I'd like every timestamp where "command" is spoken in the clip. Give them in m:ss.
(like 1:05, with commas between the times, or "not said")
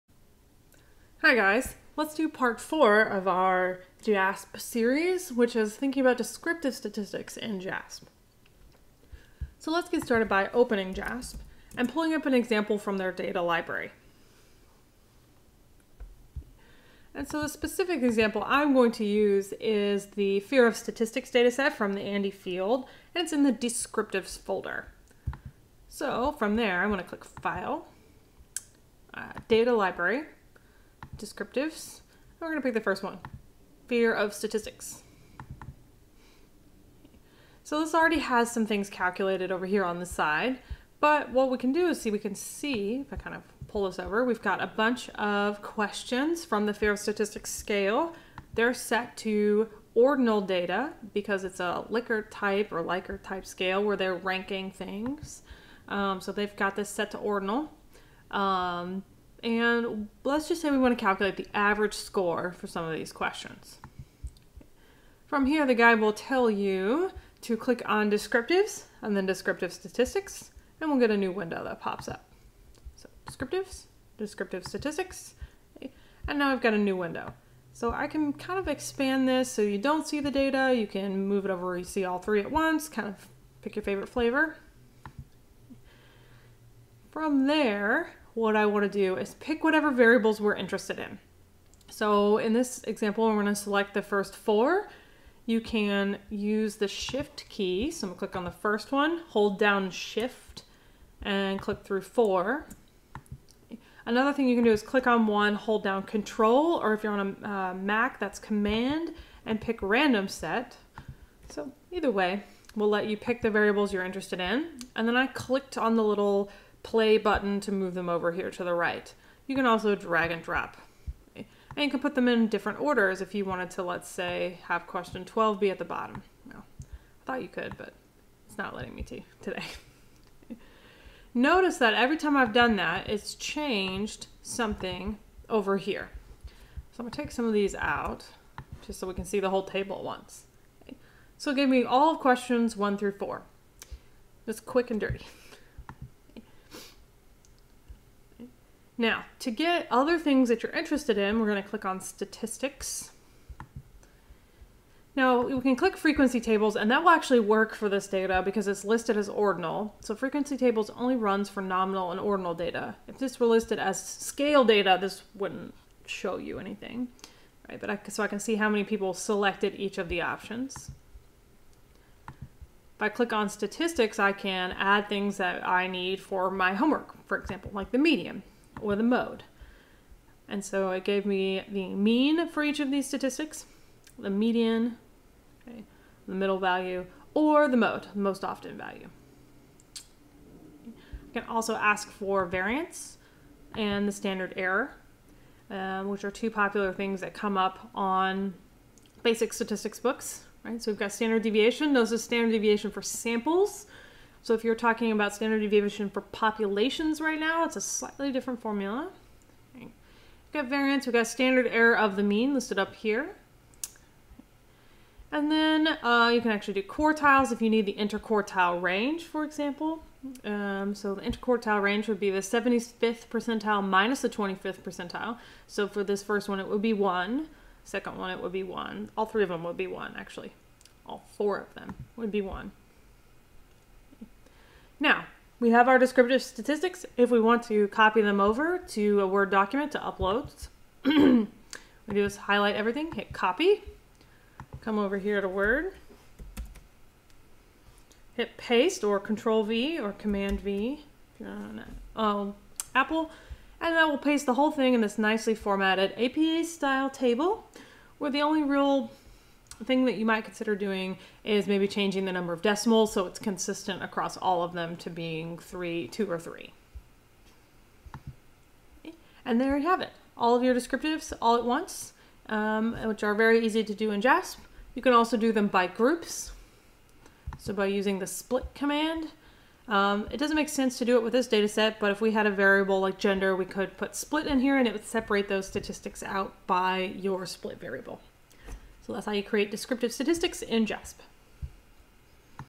1:48, 4:10, 4:38.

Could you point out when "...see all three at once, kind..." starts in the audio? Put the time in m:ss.
1:21.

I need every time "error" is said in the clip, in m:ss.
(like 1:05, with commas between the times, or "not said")
3:14, 3:31.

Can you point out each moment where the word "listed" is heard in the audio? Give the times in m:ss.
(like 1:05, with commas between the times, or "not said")
2:38, 2:43, 3:32.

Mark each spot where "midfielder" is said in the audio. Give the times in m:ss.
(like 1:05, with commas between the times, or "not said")
not said.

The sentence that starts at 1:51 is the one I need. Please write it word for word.
So either way, we'll let you pick the variables you're interested in.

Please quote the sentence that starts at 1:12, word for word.
So descriptives, descriptive statistics, and now I've got a new window.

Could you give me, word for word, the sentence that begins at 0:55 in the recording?
Um, so they've got this set to ordinal.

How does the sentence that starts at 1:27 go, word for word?
From there, what I want to do is pick whatever variables we're interested in.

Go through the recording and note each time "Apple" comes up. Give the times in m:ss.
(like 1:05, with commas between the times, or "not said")
4:12.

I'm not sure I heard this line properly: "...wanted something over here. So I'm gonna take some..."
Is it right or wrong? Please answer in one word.
wrong.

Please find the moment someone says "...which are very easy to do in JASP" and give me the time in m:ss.
4:33.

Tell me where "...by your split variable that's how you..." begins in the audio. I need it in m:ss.
4:46.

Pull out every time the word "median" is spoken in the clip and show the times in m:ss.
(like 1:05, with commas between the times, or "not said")
2:57, 3:04.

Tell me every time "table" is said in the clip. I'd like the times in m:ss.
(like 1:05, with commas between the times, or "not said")
2:19, 2:36, 2:40, 4:17.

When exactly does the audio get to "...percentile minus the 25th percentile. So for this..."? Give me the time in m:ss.
3:43.